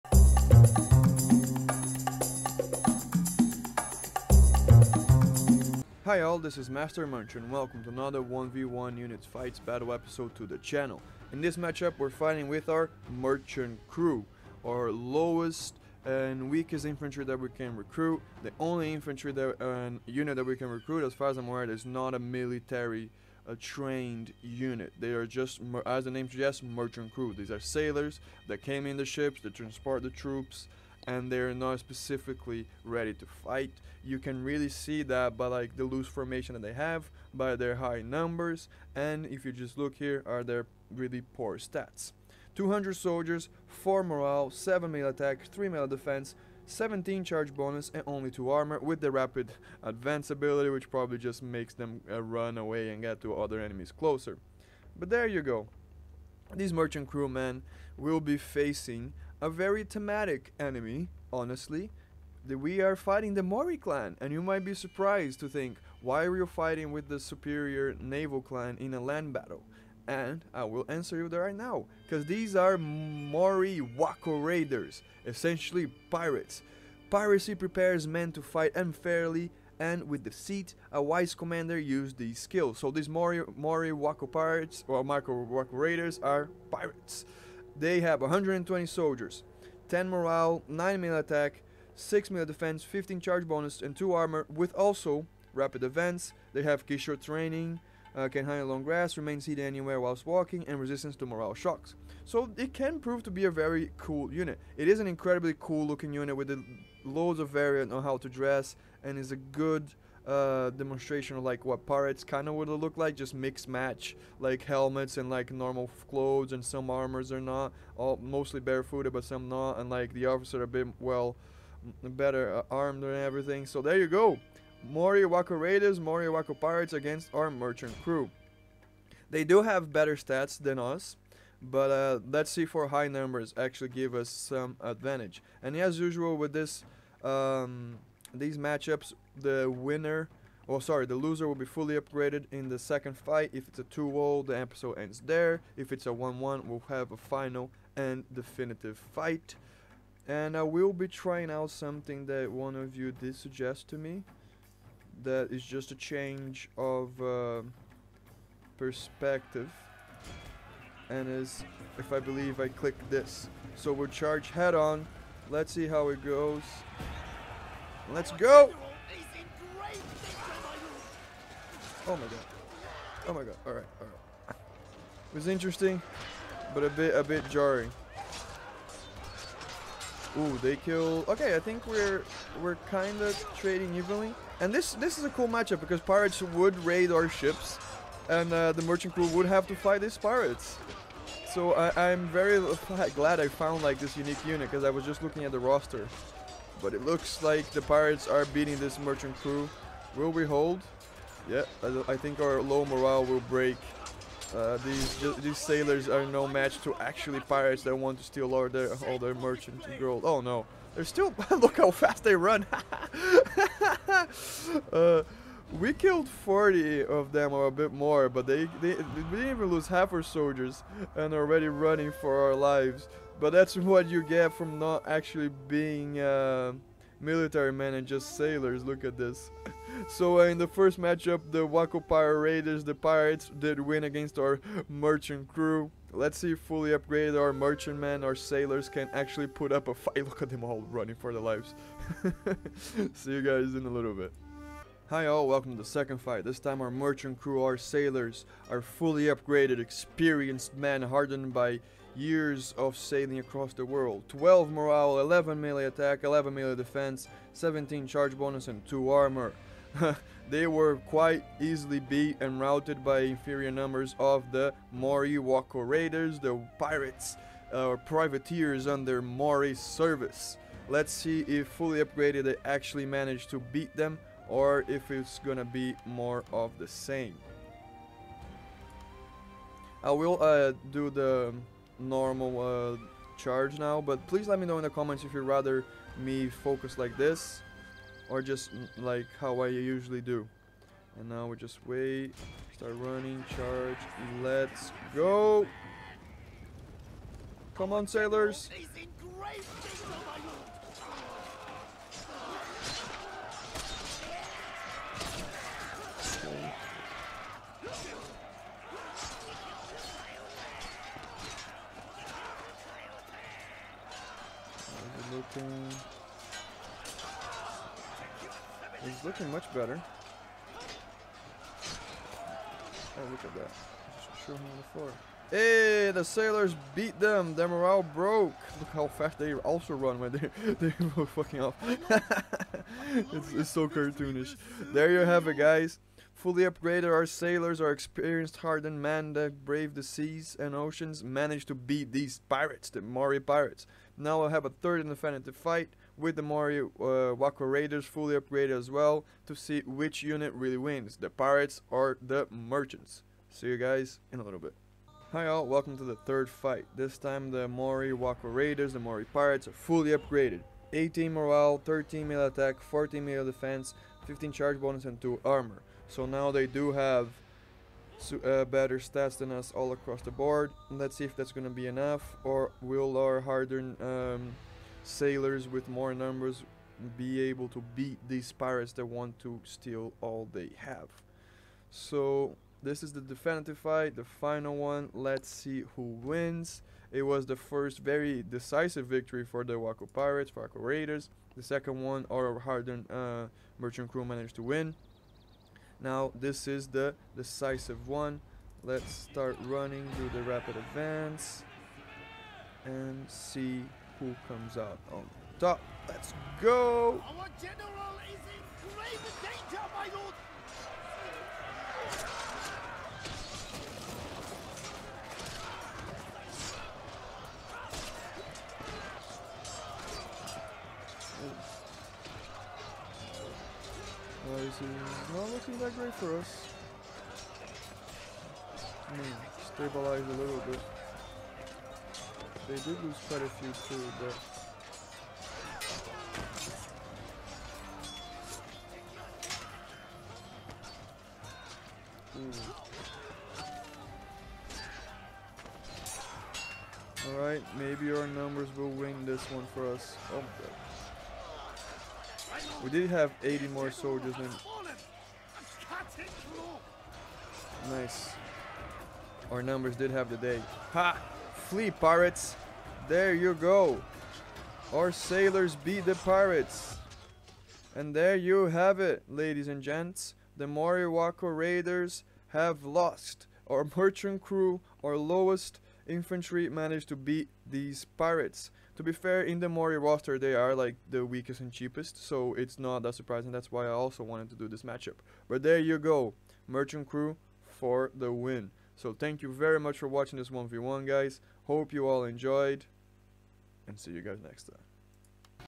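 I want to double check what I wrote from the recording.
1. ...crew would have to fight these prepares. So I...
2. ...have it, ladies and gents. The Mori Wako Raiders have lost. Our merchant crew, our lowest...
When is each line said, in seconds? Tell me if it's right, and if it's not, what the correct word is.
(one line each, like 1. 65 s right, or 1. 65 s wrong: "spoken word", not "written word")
1. 189 s wrong: "pirates", not "prepares"
2. 468 s right.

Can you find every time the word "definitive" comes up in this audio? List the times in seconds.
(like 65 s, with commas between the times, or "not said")
148 s, 383 s.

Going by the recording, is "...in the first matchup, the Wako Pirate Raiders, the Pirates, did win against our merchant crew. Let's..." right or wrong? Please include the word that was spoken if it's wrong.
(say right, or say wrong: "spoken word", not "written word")
right.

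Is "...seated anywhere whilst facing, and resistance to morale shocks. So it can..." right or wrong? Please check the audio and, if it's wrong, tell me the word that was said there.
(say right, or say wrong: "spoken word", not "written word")
wrong: "walking", not "facing".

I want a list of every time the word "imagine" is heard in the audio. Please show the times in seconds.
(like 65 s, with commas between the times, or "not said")
not said.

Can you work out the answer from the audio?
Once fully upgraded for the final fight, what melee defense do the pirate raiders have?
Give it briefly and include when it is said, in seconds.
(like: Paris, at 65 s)
14, at 362 s.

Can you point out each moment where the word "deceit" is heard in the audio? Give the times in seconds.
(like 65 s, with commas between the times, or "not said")
80 s.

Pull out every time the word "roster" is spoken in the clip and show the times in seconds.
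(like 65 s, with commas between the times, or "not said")
195 s, 479 s.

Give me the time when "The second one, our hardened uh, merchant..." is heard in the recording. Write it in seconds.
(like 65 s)
391 s.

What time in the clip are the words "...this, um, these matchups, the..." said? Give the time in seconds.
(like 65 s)
136 s.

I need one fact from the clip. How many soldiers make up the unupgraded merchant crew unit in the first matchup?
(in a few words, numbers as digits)
200.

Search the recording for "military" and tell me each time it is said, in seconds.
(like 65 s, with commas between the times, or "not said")
22 s, 227 s.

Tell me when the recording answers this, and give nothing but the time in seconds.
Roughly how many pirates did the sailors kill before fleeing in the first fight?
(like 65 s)
216 s.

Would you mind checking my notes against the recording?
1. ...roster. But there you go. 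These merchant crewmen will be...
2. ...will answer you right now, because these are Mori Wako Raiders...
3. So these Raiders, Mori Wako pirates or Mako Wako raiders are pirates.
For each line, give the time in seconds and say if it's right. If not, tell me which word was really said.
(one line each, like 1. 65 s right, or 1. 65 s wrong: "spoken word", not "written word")
1. 53 s wrong: "closer", not "roster"
2. 70 s right
3. 82 s wrong: "Mori", not "Raiders".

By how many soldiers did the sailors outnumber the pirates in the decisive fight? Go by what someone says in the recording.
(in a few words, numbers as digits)
80.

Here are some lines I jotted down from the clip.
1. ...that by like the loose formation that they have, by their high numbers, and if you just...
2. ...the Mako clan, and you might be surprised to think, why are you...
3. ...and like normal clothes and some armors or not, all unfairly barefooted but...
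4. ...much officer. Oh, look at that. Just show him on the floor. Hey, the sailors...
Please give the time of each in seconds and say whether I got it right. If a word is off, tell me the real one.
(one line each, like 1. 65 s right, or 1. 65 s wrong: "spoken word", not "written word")
1. 35 s right
2. 63 s wrong: "Mori", not "Mako"
3. 115 s wrong: "mostly", not "unfairly"
4. 319 s wrong: "better", not "officer".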